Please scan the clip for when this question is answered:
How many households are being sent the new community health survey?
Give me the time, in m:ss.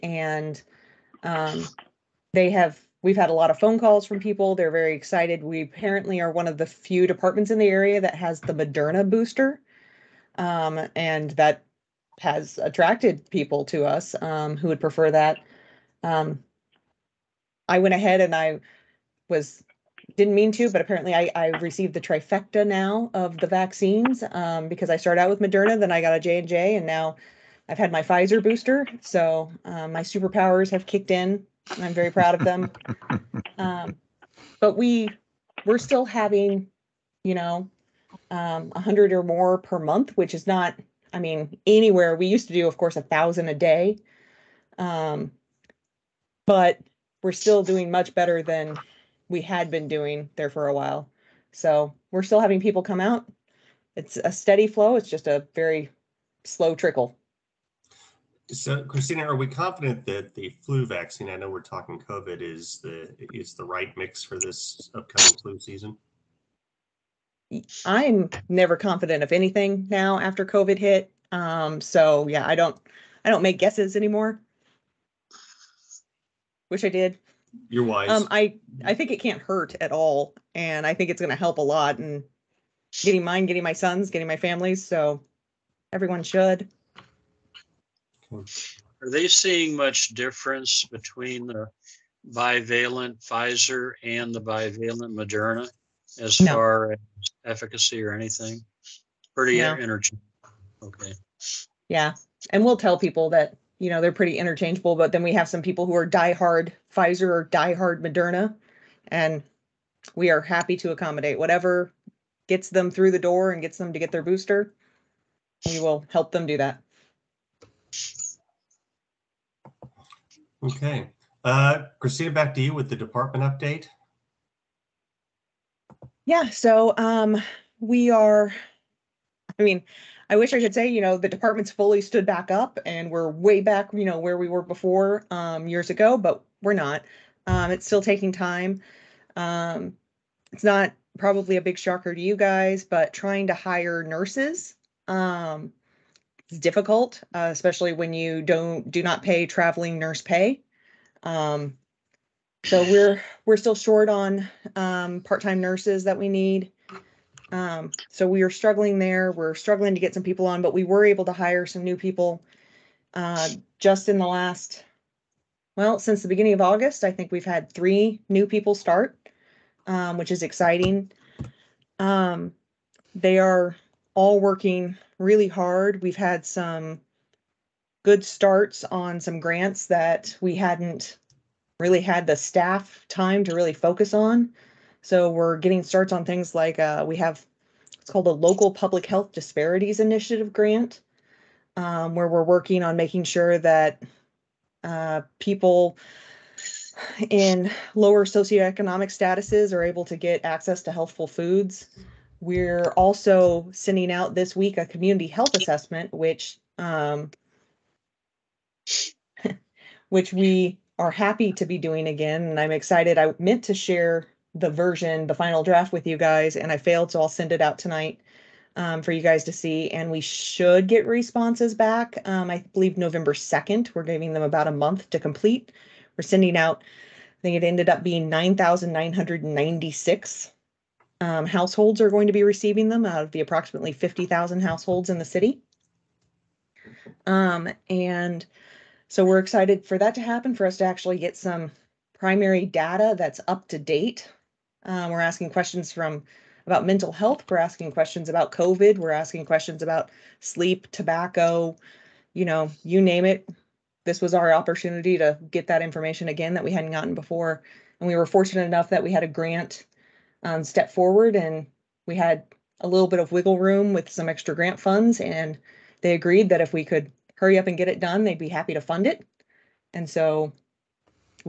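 3:48.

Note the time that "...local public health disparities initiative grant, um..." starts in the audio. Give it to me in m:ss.
3:08.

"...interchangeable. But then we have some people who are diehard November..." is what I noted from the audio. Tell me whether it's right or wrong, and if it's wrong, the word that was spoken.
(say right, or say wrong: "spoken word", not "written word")
wrong: "Pfizer", not "November".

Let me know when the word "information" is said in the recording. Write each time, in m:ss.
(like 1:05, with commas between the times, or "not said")
4:15.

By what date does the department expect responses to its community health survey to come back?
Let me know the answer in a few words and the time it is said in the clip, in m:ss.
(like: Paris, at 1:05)
November 2nd, at 3:42.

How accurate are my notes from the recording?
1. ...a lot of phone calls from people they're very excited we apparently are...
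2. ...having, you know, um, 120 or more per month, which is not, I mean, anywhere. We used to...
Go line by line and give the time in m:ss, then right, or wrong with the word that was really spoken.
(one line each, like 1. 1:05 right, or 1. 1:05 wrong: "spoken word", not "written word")
1. 0:03 right
2. 0:36 wrong: "100", not "120".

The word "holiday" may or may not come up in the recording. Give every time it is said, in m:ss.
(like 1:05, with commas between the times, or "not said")
not said.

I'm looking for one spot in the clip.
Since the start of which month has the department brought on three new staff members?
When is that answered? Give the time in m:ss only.
2:46.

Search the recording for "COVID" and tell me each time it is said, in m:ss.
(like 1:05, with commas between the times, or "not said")
1:02, 1:10, 4:08.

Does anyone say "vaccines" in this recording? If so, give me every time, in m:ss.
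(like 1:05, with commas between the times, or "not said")
0:23, 1:00.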